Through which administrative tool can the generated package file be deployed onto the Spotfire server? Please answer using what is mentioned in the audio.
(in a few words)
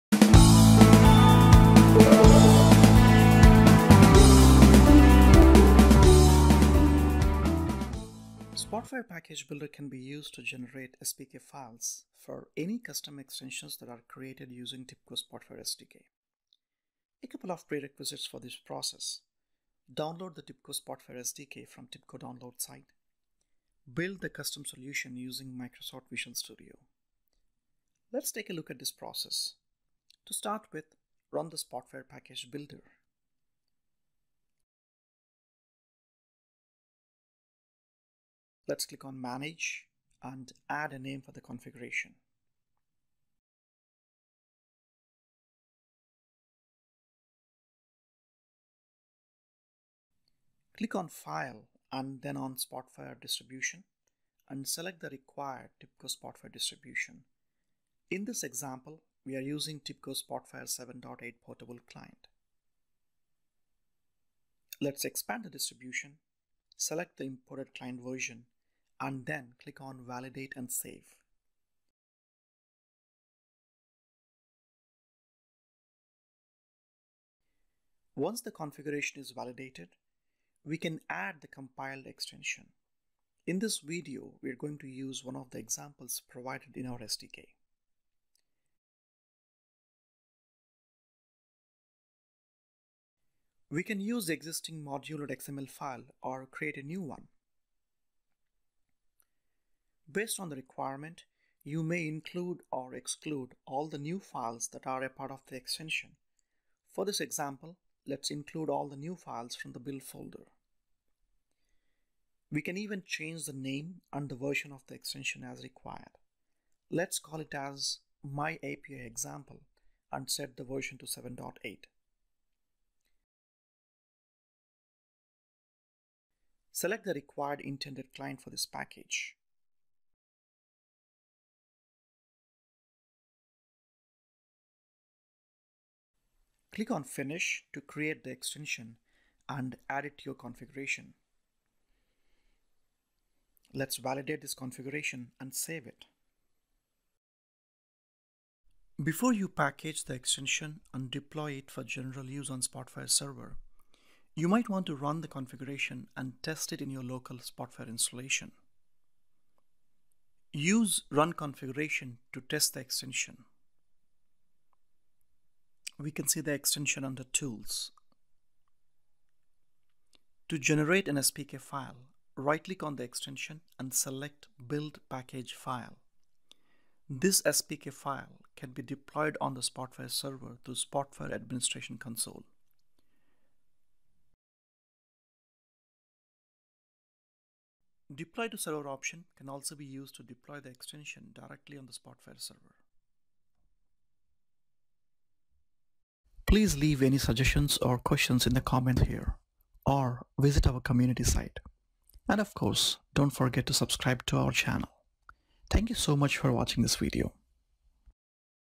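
Spotfire Administration Console.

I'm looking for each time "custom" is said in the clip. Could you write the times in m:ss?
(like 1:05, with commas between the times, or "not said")
0:12, 0:24.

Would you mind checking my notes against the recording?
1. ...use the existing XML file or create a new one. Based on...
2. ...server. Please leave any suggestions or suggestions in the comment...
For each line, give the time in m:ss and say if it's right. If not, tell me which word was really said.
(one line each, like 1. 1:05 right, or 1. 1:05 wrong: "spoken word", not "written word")
1. 1:33 right
2. 3:12 wrong: "questions", not "suggestions".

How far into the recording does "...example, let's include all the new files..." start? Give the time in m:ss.
1:47.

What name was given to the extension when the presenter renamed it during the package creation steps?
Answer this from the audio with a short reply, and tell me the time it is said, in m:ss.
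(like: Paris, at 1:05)
my API example, at 1:58.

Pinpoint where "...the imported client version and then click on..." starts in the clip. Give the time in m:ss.
1:07.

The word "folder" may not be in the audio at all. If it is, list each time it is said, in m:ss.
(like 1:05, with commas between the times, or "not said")
1:50.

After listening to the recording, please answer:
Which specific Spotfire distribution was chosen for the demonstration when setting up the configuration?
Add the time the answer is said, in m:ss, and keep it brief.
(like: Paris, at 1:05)
TIBCO Spotfire 7.8 portable client, at 0:59.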